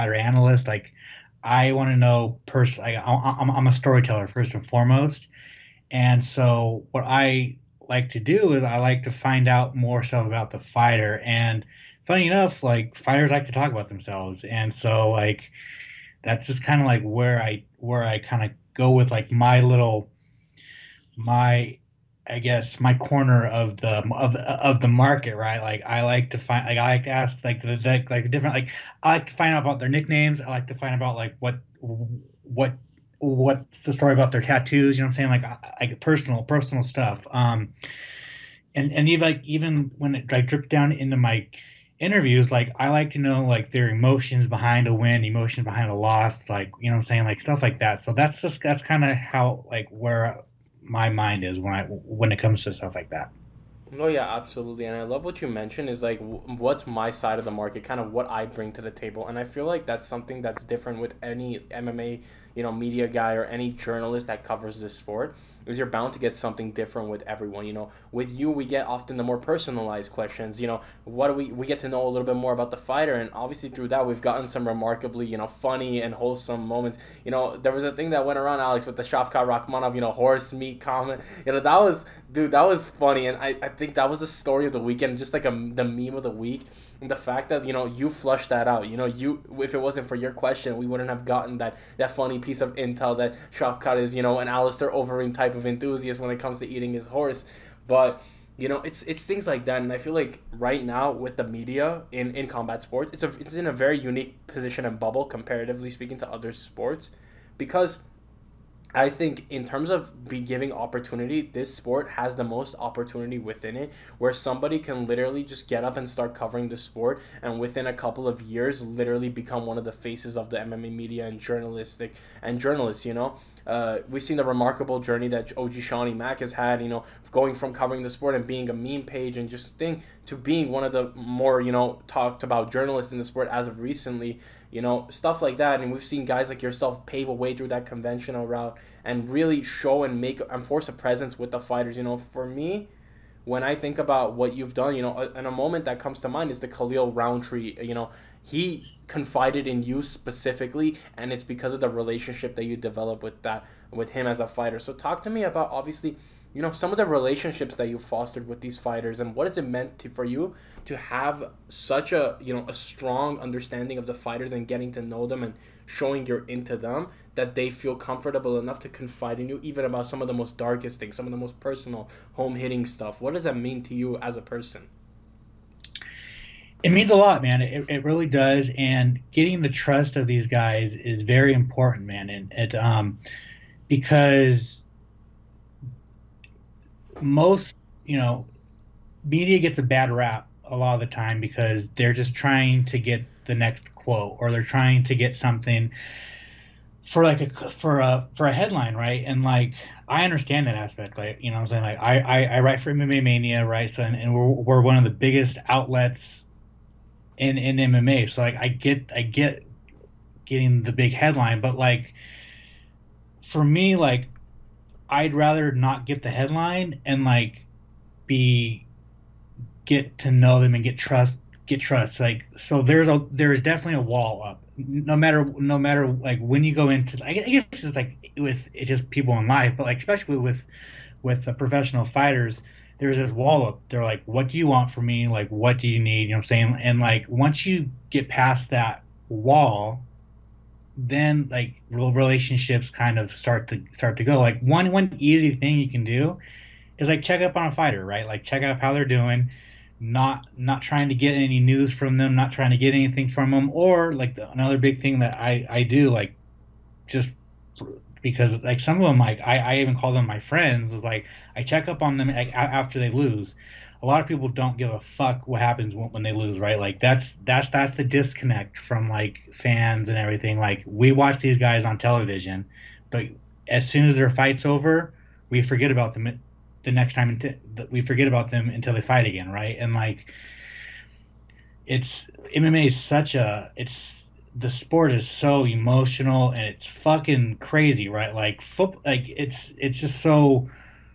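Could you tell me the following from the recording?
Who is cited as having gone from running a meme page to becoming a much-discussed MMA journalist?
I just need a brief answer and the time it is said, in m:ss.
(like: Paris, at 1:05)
OG Shawnee Mack, at 2:05.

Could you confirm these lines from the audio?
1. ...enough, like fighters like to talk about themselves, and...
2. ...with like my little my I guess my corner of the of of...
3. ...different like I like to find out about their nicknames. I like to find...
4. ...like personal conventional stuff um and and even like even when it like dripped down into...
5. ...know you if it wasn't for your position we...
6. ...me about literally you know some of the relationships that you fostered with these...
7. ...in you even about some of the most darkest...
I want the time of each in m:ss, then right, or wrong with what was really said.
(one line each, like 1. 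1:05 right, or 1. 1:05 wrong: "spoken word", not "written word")
1. 0:12 right
2. 0:18 right
3. 0:28 right
4. 0:35 wrong: "personal", not "conventional"
5. 1:28 wrong: "question", not "position"
6. 2:35 wrong: "obviously", not "literally"
7. 2:49 right.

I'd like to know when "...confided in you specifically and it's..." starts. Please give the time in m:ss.
2:29.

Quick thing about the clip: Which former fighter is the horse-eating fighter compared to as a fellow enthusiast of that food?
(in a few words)
Alistair Overeem.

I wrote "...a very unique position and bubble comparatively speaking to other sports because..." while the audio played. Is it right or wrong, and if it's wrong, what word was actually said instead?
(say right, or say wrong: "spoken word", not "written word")
right.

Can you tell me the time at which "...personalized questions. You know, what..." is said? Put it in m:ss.
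1:09.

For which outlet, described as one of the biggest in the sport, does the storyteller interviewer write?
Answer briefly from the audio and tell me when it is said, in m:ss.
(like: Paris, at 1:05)
MMA Mania, at 3:22.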